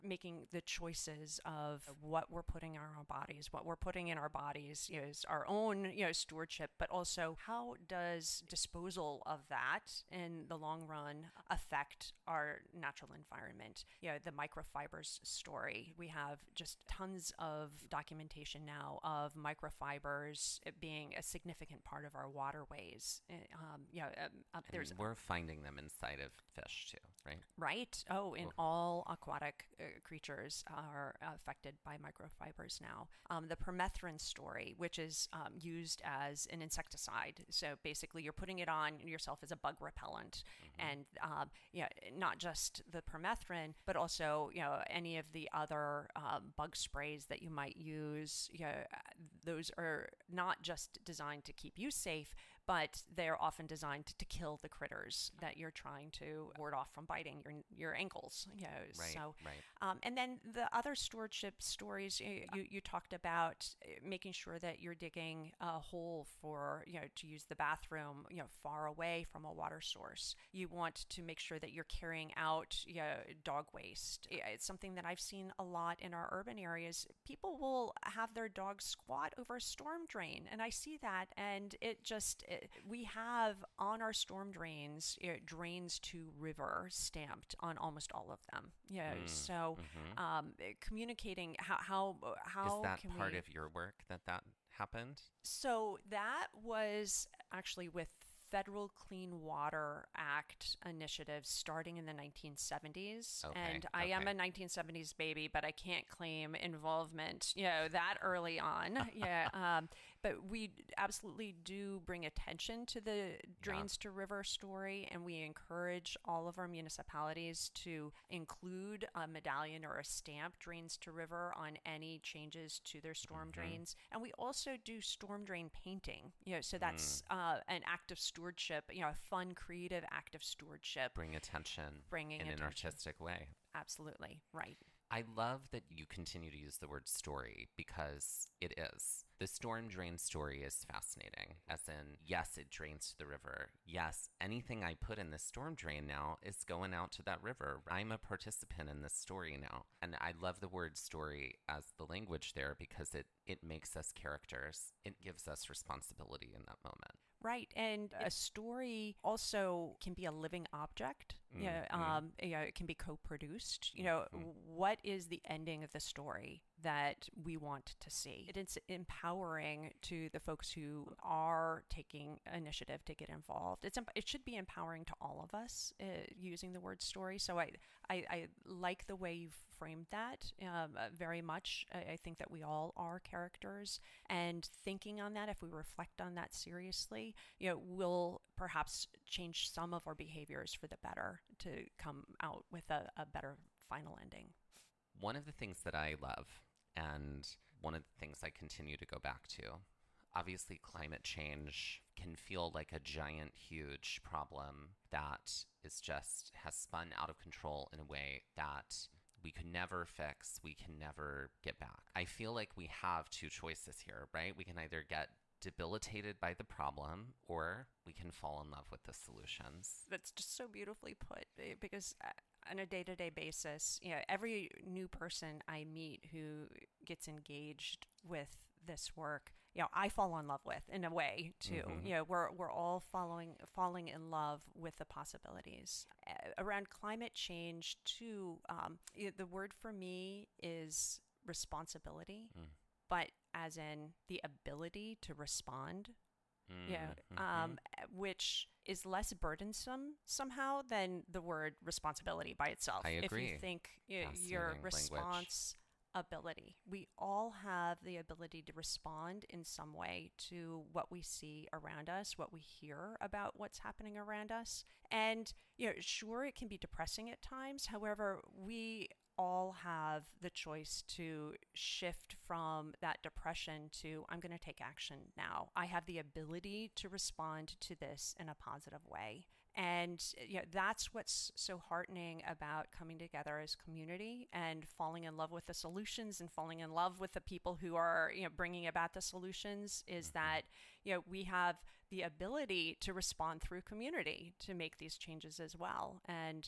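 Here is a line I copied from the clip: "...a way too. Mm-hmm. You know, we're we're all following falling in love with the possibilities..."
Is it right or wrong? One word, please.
right.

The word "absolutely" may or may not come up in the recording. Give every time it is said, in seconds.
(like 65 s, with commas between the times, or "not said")
110 s, 133 s.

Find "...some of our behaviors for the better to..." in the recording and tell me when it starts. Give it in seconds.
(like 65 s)
189 s.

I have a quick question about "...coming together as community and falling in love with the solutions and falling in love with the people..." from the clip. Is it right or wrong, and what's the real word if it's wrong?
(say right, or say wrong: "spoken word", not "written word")
right.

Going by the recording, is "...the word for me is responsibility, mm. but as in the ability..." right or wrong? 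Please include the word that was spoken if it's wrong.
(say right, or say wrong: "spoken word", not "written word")
right.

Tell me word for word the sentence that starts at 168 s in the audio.
It is empowering to the folks who are taking initiative to get involved.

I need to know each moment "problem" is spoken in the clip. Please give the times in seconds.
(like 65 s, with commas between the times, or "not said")
204 s, 216 s.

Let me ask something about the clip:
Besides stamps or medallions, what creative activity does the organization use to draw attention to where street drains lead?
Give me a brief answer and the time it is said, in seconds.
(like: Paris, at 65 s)
storm drain painting, at 125 s.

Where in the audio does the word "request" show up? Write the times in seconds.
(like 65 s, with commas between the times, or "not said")
not said.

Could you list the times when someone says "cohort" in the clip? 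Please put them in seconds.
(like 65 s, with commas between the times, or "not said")
not said.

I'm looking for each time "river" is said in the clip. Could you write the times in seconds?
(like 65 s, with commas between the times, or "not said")
86 s, 114 s, 121 s, 143 s, 147 s.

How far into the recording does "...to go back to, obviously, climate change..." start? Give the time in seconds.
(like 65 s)
198 s.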